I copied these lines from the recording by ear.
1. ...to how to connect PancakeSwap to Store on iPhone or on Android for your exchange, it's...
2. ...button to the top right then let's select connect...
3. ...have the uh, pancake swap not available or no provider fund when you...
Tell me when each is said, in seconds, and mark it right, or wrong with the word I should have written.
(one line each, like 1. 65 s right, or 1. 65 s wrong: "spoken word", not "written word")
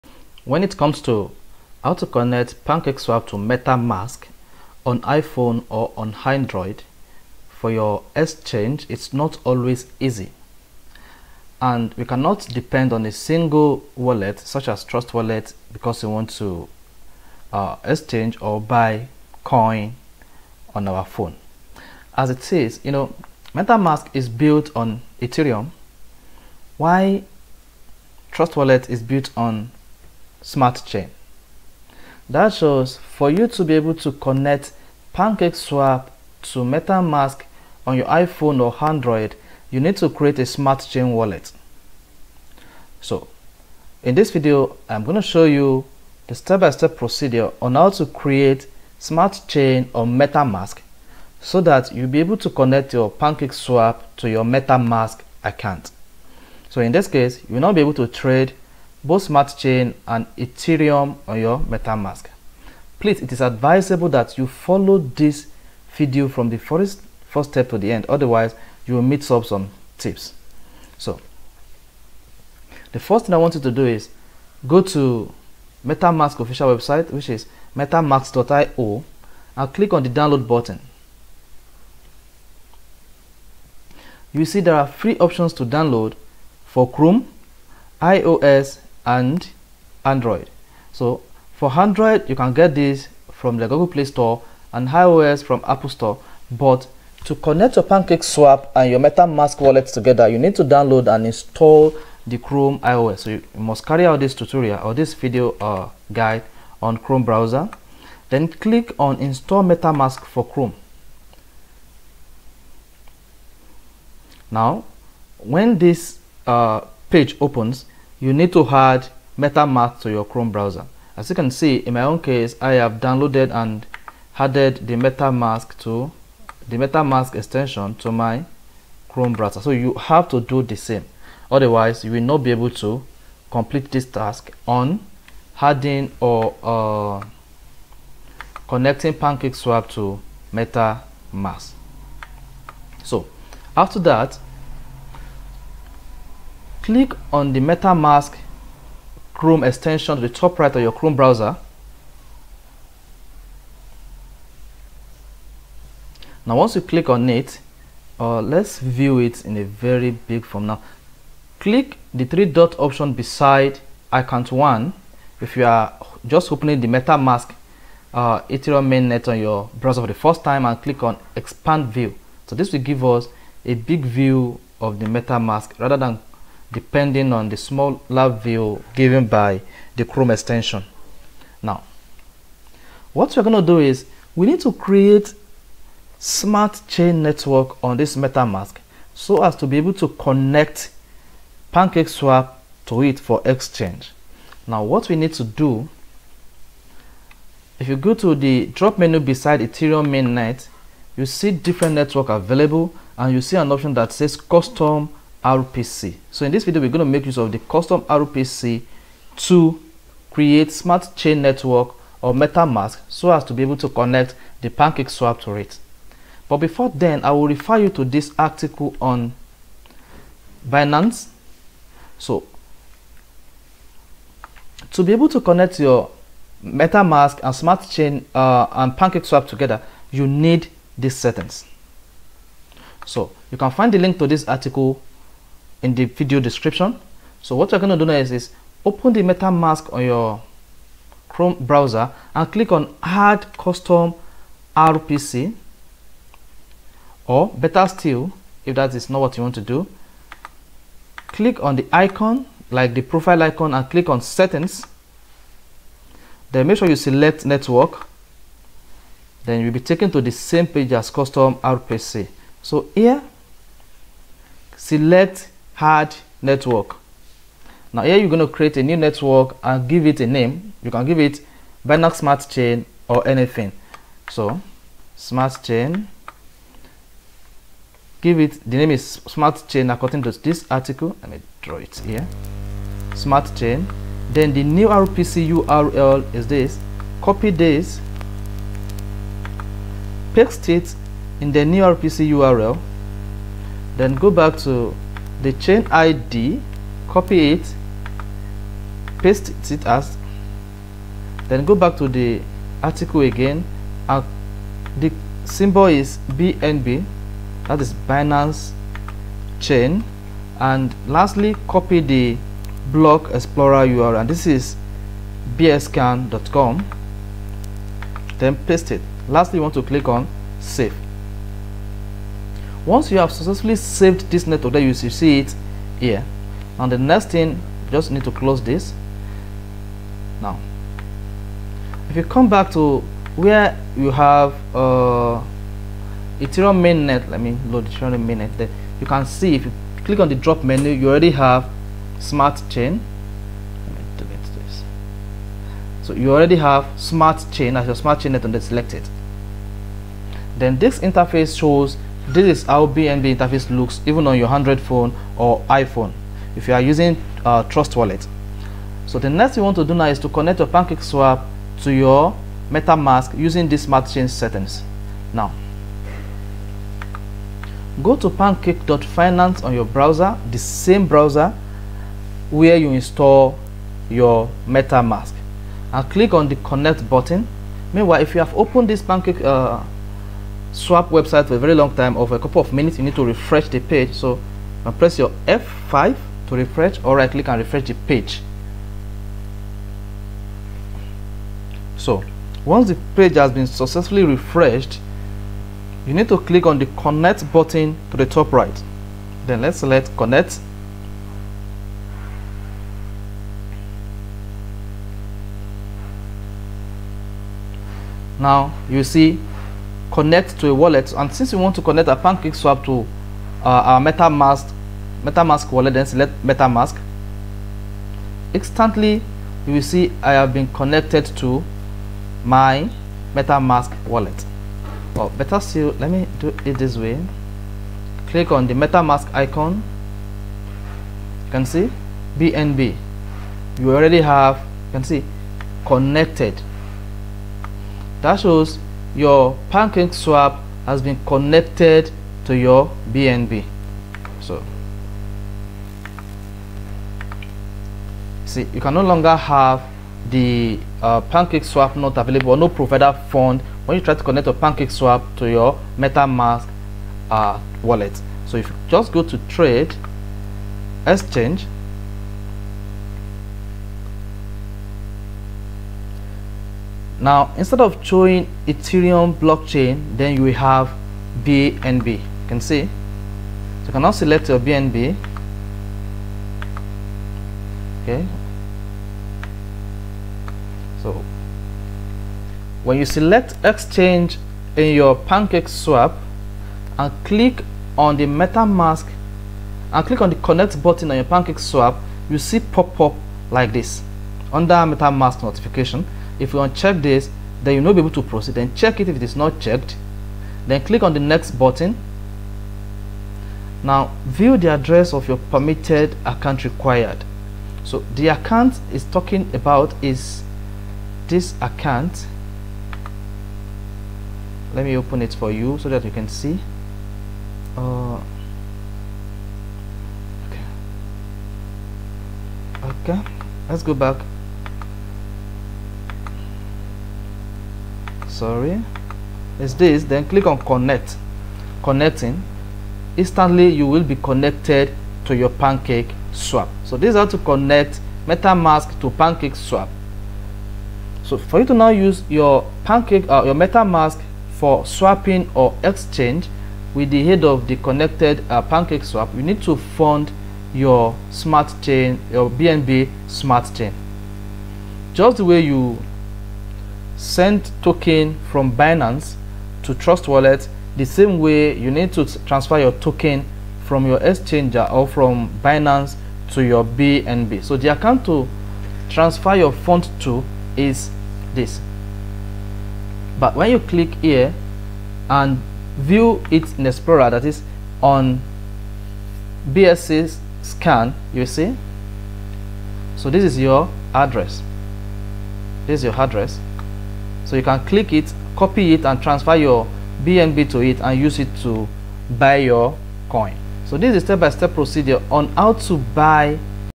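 1. 1 s wrong: "MetaMask", not "Store"
2. 397 s right
3. 449 s right.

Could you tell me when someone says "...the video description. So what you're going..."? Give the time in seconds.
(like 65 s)
235 s.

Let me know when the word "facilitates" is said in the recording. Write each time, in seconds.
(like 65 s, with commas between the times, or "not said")
not said.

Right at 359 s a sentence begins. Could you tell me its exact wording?
So the next you want to do now is to connect your PancakeSwap to your MetaMask using these smart chain settings.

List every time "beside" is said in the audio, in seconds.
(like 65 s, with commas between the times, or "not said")
163 s, 199 s.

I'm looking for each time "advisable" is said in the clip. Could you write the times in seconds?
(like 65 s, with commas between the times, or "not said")
63 s.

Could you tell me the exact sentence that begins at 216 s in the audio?
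But before then, I will refer you to this article on Binance.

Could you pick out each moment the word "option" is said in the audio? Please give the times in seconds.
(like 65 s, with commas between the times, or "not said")
85 s, 162 s, 203 s.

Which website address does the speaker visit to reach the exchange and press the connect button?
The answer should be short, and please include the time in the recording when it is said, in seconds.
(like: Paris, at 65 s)
pancake.finance, at 368 s.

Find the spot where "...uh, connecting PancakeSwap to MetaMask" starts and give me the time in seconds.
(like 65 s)
136 s.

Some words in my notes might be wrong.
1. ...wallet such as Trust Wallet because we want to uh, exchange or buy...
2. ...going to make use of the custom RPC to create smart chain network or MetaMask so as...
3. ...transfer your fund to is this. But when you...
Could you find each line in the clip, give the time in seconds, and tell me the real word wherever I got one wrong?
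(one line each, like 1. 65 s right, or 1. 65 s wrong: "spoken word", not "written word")
1. 13 s right
2. 206 s right
3. 569 s right.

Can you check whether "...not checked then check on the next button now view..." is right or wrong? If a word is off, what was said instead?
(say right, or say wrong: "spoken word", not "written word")
wrong: "click", not "check".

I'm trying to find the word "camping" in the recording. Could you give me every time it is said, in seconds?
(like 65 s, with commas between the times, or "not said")
not said.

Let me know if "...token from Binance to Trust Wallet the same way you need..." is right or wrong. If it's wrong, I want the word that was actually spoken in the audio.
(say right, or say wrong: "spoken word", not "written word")
right.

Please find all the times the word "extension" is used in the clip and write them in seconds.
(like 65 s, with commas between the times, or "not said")
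127 s, 149 s, 180 s.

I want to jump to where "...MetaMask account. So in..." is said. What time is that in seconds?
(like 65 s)
54 s.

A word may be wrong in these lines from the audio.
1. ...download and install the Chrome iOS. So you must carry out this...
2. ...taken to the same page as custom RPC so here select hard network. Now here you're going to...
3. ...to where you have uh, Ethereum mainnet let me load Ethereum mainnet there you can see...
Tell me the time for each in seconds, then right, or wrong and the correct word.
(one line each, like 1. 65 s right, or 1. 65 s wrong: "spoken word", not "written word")
1. 100 s right
2. 259 s right
3. 332 s right.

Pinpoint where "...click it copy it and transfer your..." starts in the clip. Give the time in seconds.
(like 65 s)
587 s.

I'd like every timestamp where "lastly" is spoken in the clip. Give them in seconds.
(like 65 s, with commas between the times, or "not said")
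311 s, 319 s.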